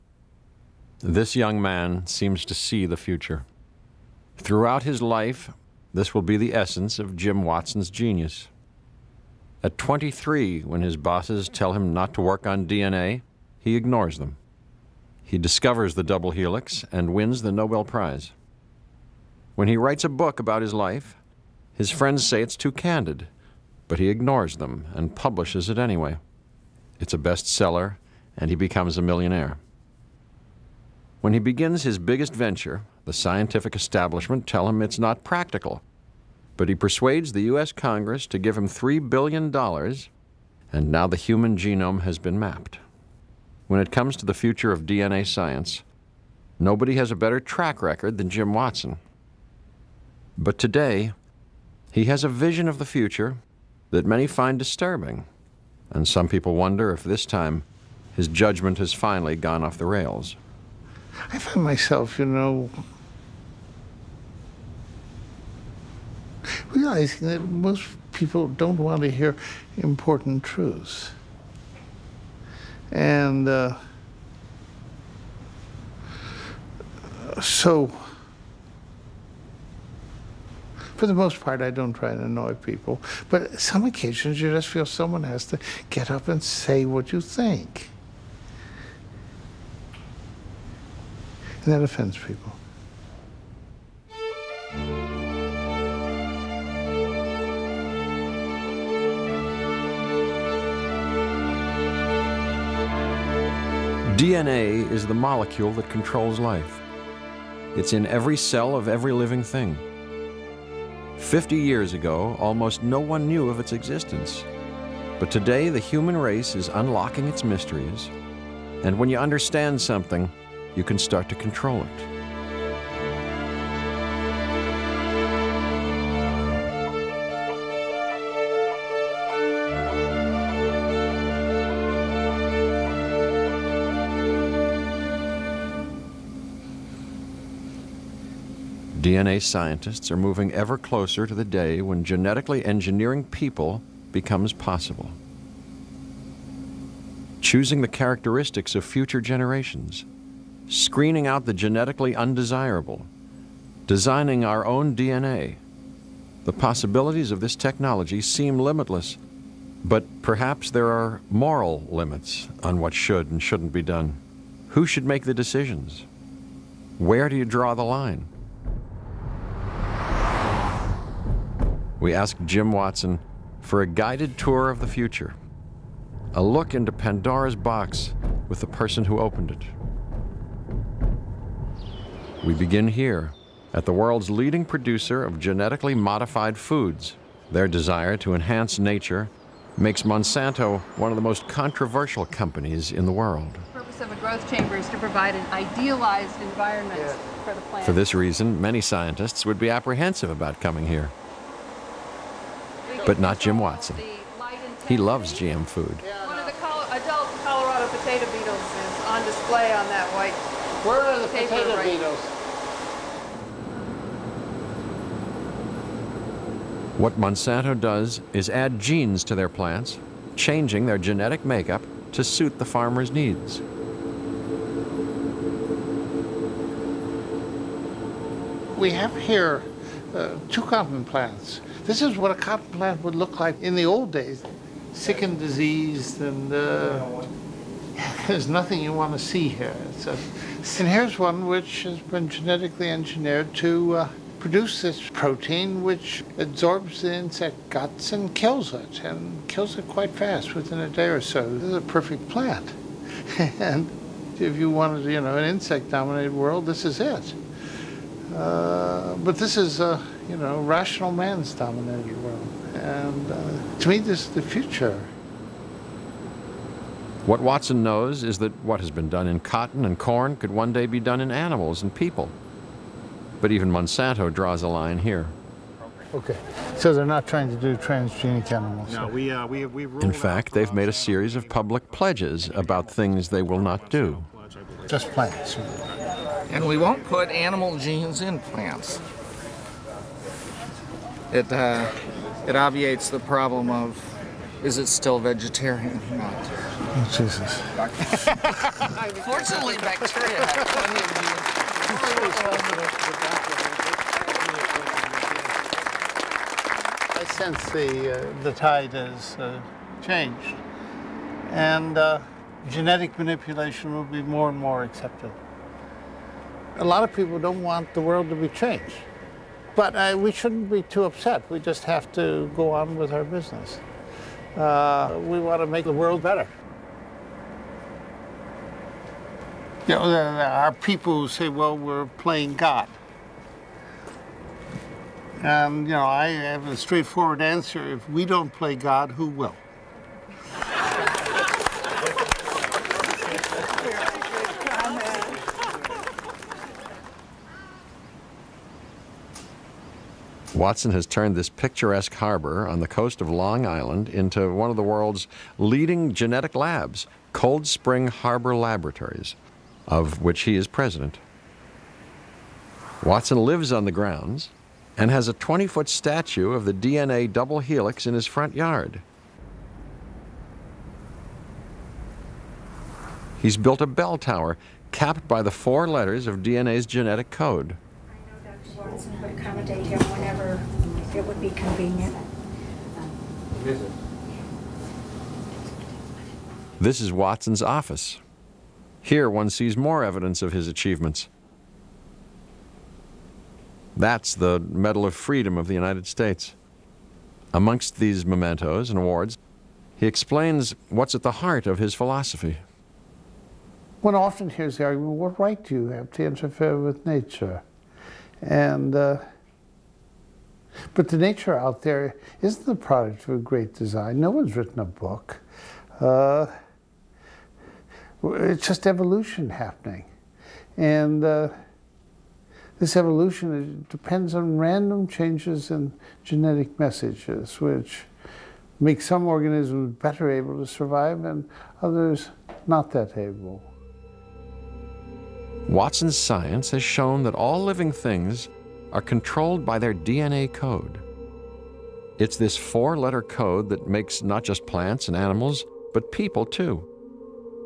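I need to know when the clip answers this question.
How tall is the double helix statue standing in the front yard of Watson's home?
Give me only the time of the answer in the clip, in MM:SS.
06:05.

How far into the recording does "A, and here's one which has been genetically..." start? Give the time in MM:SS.
04:00.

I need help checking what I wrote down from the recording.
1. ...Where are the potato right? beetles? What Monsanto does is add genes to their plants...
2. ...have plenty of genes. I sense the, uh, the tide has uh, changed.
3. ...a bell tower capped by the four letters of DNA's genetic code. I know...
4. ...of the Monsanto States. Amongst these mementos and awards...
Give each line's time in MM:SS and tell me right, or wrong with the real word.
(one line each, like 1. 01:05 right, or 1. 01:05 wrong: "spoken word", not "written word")
1. 03:30 right
2. 05:00 right
3. 06:13 right
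4. 06:35 wrong: "United", not "Monsanto".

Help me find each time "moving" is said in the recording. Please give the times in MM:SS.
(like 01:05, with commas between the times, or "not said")
02:20.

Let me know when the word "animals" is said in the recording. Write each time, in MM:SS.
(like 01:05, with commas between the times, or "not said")
04:31, 04:38, 04:47, 07:25.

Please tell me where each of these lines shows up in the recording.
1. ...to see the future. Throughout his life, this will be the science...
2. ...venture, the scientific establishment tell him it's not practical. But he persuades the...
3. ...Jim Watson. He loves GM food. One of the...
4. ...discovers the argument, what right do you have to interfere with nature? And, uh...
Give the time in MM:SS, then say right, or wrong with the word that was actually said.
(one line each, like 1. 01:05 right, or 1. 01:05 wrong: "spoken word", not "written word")
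1. 00:02 wrong: "essence", not "science"
2. 00:32 right
3. 03:23 right
4. 06:44 wrong: "hears", not "discovers".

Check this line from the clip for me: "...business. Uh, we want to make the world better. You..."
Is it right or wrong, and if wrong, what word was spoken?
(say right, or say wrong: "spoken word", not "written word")
right.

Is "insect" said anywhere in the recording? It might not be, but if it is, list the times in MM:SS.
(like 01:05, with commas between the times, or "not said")
04:07, 04:15.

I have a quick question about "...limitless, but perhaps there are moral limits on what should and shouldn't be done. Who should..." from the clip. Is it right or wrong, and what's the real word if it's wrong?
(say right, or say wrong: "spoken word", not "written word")
right.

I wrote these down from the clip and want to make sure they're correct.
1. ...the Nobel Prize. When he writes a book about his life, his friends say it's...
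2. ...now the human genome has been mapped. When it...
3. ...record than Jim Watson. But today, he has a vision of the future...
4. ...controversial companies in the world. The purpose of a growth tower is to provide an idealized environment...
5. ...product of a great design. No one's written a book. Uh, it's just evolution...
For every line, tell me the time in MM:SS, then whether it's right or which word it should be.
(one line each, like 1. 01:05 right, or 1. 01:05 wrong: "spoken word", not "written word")
1. 00:17 right
2. 00:40 right
3. 00:47 right
4. 03:11 wrong: "chamber", not "tower"
5. 06:52 right.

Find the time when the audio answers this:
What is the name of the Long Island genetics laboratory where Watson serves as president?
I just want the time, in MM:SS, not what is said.
05:57.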